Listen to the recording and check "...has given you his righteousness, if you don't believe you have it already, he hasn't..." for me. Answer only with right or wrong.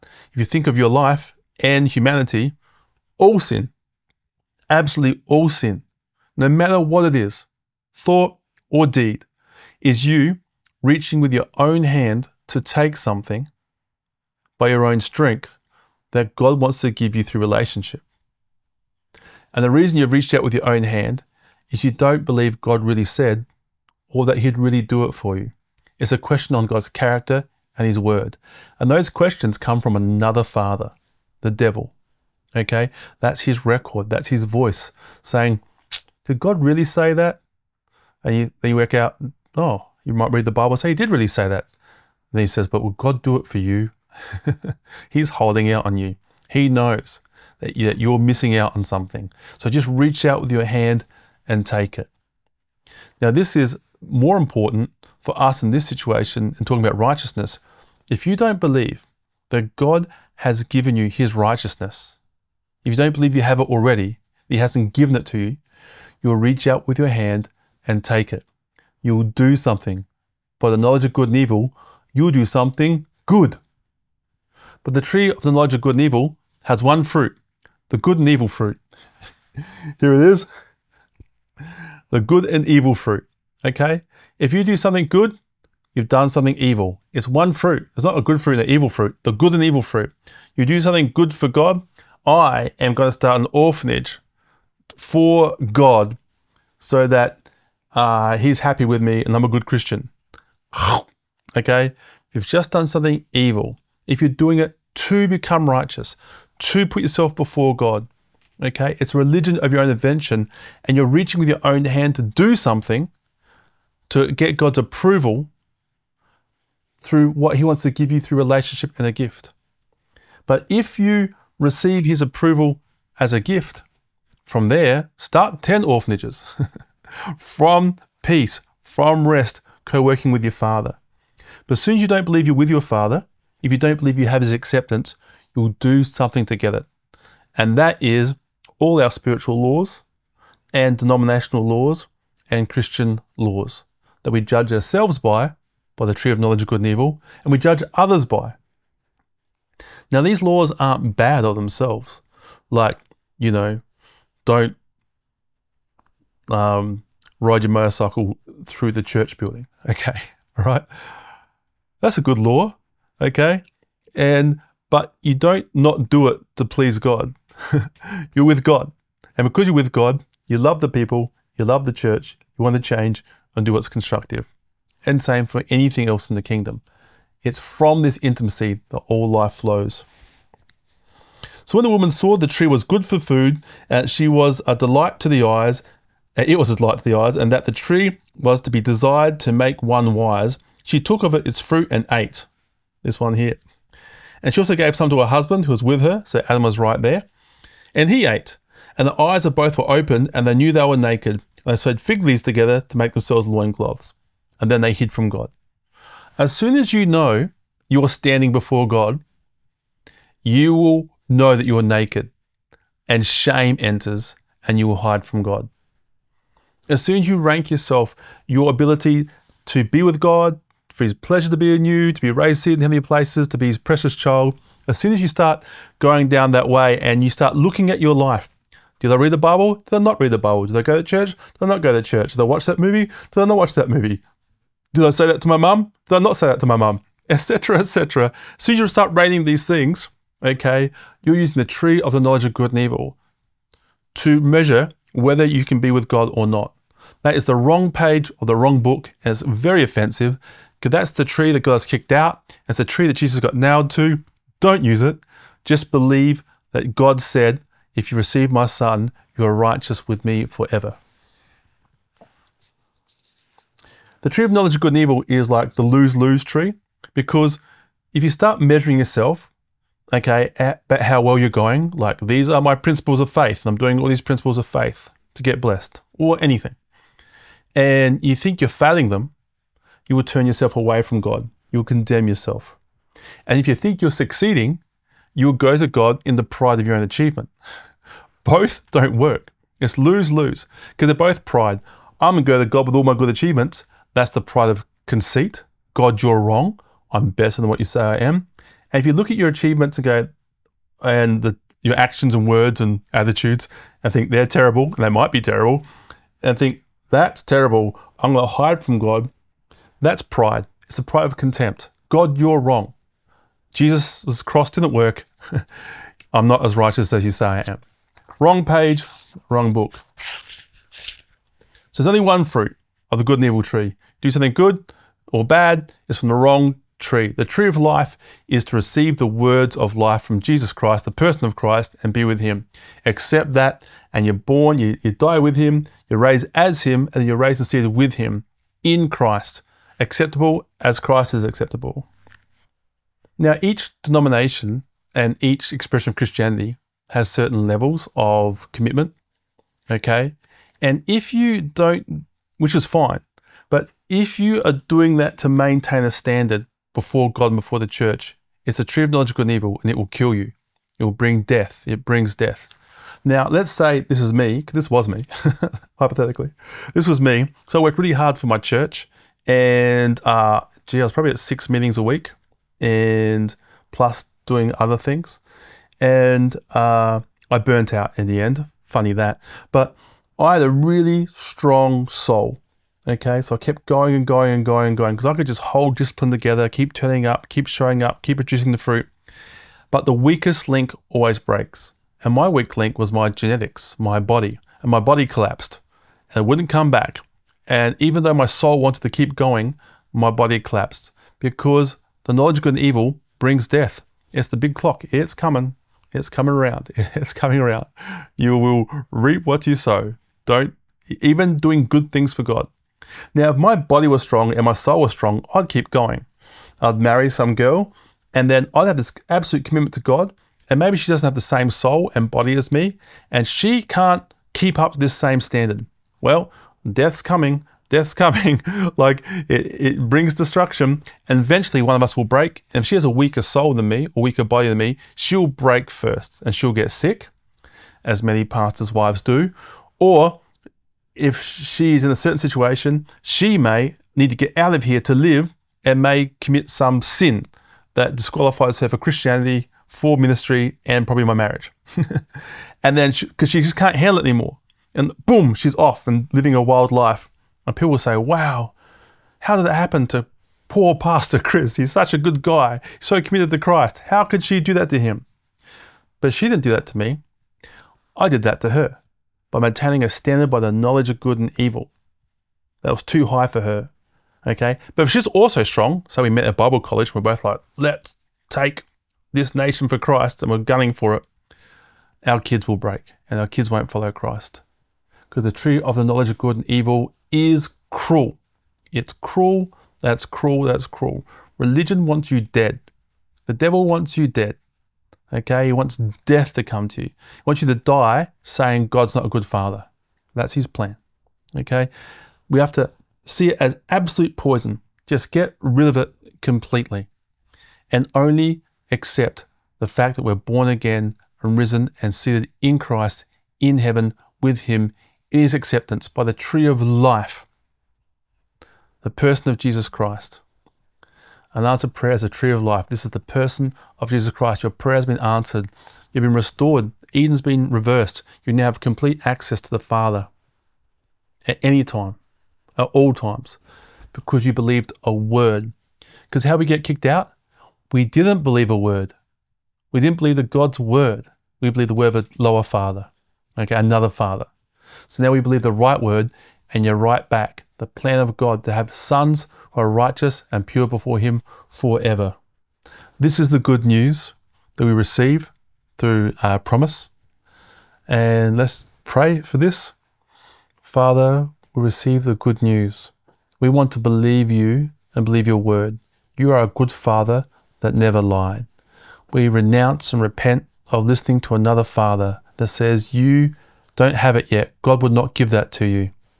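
right.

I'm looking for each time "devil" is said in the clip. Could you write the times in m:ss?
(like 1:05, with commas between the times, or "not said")
0:31, 8:13.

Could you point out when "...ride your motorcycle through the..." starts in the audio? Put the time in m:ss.
2:37.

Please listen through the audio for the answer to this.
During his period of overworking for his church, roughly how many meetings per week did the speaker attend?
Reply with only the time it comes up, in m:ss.
6:11.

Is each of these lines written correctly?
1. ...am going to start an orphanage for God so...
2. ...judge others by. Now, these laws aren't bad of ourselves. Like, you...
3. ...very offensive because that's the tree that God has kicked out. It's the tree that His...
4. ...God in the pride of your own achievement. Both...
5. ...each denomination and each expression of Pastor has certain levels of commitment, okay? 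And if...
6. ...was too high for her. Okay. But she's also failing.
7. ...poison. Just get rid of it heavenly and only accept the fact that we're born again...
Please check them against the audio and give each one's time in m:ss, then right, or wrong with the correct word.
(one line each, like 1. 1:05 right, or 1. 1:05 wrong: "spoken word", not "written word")
1. 1:32 right
2. 2:27 wrong: "themselves", not "ourselves"
3. 4:09 wrong: "Jesus", not "His"
4. 4:45 right
5. 5:43 wrong: "Christianity", not "Pastor"
6. 7:52 wrong: "strong", not "failing"
7. 8:24 wrong: "completely", not "heavenly".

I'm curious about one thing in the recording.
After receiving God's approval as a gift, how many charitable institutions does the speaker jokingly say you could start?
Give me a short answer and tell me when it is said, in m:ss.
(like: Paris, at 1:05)
10, at 2:05.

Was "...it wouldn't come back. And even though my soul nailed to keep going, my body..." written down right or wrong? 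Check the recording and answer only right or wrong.
wrong.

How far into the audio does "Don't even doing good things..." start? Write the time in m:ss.
6:50.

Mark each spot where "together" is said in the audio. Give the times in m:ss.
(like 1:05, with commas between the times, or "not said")
3:22, 6:26.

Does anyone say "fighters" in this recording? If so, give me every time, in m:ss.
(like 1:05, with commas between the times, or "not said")
not said.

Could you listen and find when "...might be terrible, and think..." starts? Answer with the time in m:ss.
5:05.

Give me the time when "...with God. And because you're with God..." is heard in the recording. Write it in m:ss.
2:48.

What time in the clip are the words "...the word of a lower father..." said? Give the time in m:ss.
9:01.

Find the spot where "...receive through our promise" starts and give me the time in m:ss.
9:14.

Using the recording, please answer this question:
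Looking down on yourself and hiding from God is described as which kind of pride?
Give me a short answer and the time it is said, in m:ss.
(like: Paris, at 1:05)
pride of contempt, at 5:11.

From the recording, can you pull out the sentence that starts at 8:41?
And answer prayer is a tree of life.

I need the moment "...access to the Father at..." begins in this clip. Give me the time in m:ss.
8:49.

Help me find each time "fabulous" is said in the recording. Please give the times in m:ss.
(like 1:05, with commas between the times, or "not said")
not said.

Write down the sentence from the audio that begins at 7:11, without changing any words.
And eventually one of us will break.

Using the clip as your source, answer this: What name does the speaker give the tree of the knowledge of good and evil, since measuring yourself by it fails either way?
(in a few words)
the lose lose tree.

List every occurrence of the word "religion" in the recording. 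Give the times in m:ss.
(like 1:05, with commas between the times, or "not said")
1:49, 8:11.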